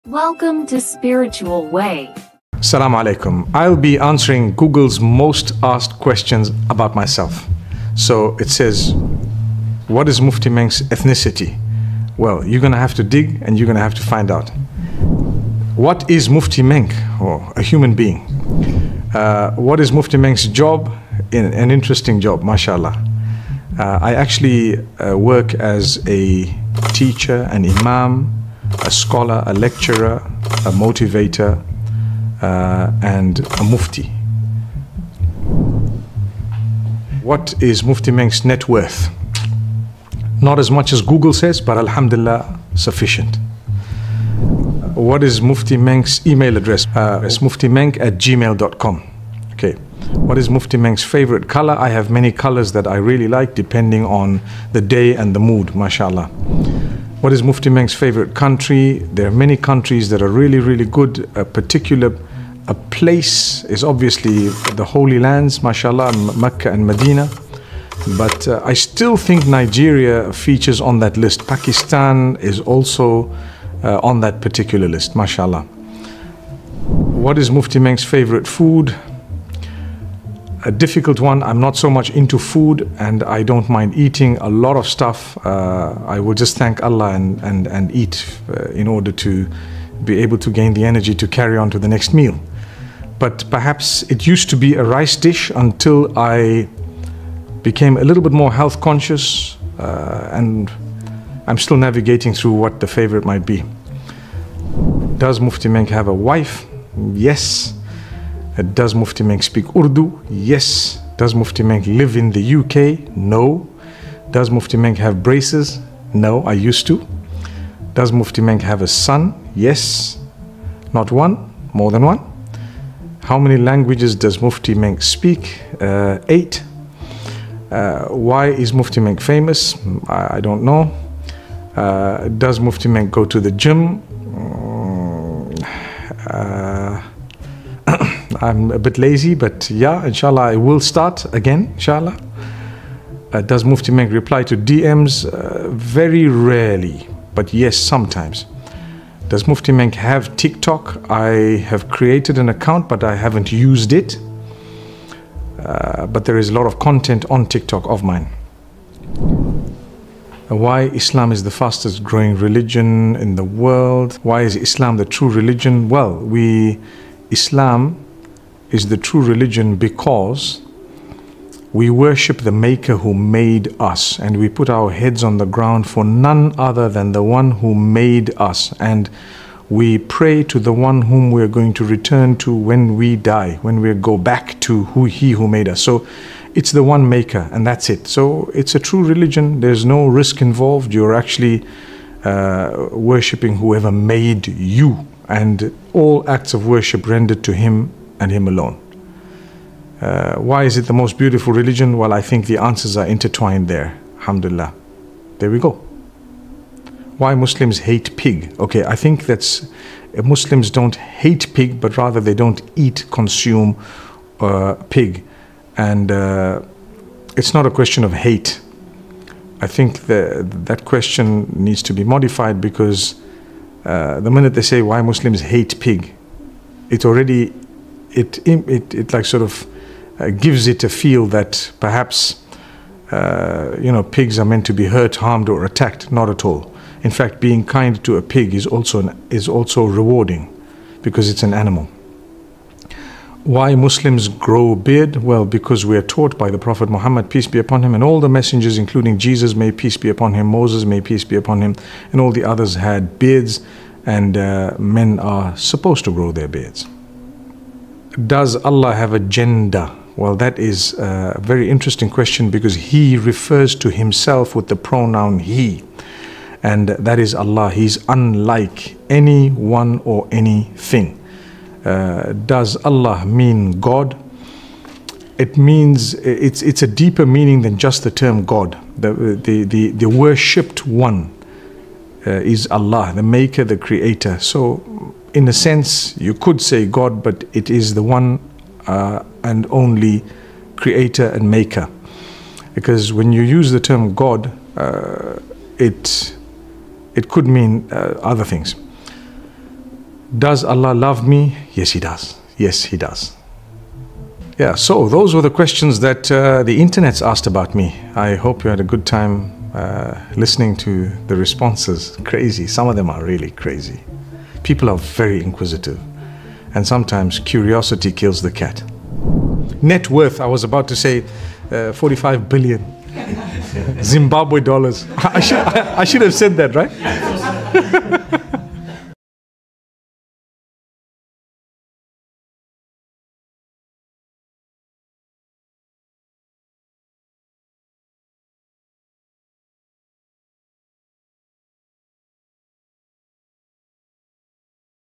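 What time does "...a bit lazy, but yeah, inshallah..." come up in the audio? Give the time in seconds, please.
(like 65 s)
138 s.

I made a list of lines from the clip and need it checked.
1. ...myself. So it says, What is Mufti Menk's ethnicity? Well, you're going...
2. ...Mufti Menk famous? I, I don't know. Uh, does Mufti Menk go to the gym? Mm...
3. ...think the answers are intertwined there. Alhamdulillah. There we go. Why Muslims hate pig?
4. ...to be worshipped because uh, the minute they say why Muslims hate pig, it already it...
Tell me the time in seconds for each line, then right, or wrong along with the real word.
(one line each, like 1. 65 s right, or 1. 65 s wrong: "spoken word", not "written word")
1. 6 s right
2. 128 s right
3. 202 s right
4. 221 s wrong: "modified", not "worshipped".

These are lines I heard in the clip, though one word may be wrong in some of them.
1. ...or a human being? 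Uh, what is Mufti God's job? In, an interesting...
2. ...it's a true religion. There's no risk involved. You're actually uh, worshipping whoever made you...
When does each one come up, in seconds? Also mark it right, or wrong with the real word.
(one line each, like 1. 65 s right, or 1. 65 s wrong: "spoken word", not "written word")
1. 17 s wrong: "Menk", not "God"
2. 188 s right.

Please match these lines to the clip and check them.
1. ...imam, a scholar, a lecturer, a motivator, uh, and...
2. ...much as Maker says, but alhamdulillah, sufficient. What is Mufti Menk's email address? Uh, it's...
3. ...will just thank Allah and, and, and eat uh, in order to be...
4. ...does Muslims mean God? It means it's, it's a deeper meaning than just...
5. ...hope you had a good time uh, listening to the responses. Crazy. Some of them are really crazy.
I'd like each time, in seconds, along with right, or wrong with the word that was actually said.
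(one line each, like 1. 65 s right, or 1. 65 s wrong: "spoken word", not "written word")
1. 27 s right
2. 40 s wrong: "Google", not "Maker"
3. 86 s right
4. 272 s wrong: "Allah", not "Muslims"
5. 308 s right.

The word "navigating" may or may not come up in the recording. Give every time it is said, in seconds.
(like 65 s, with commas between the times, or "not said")
101 s.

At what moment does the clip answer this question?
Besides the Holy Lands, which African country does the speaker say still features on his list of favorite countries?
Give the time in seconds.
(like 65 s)
69 s.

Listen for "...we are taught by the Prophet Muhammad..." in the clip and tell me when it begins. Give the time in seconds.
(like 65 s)
245 s.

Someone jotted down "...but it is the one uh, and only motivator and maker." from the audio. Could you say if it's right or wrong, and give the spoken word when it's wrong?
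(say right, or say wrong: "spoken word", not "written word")
wrong: "creator", not "motivator".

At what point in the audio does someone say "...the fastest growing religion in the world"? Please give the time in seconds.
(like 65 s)
161 s.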